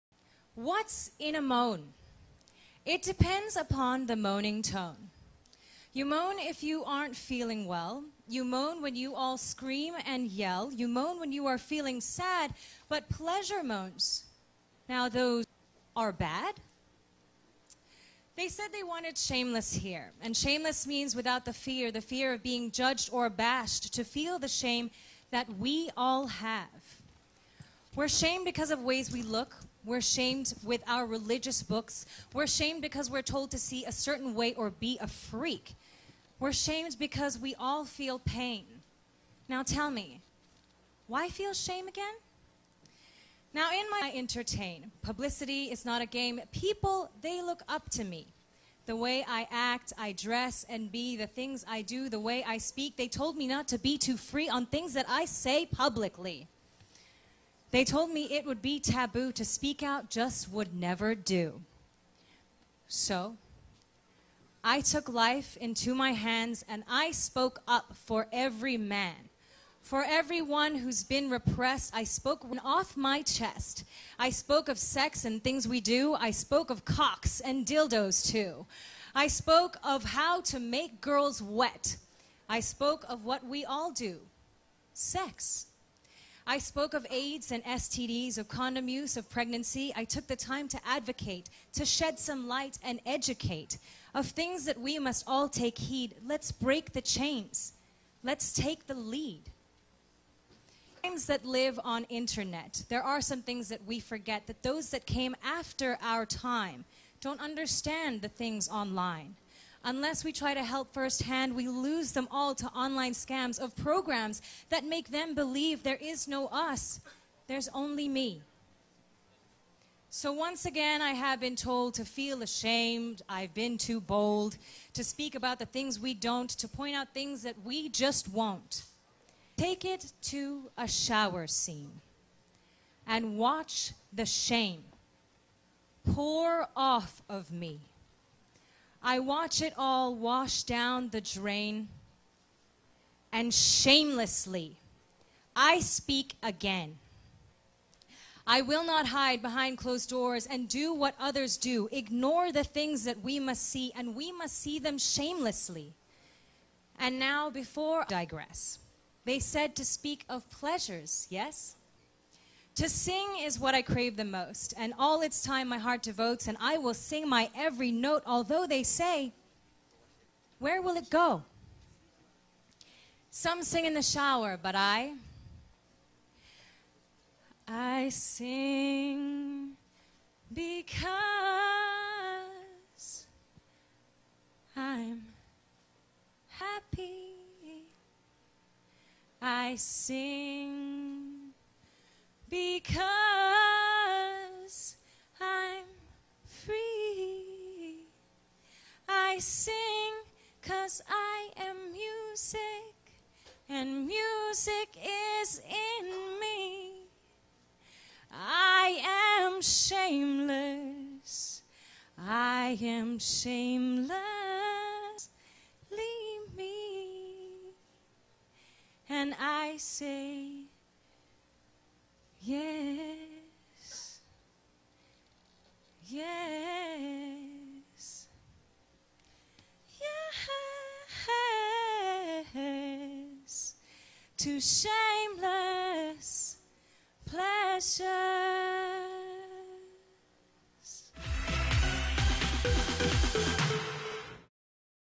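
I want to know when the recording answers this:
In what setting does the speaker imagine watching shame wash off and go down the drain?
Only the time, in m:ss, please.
2:10.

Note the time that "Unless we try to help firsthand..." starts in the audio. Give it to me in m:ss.
1:49.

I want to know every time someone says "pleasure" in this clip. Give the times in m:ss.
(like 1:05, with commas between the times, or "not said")
0:13, 2:40, 3:57.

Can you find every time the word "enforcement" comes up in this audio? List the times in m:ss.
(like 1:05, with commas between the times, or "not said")
not said.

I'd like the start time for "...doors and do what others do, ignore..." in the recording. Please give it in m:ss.
2:30.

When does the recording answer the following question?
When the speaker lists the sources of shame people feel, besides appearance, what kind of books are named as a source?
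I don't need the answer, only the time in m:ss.
0:31.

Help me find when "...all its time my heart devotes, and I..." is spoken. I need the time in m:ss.
2:44.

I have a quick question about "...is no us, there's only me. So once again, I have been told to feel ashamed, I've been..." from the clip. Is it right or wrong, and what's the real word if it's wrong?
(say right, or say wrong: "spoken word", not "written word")
right.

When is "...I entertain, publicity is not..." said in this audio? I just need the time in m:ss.
0:44.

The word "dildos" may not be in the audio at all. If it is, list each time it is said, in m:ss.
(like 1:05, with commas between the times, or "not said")
1:17.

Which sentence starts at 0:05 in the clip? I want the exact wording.
You moan if you aren't feeling well.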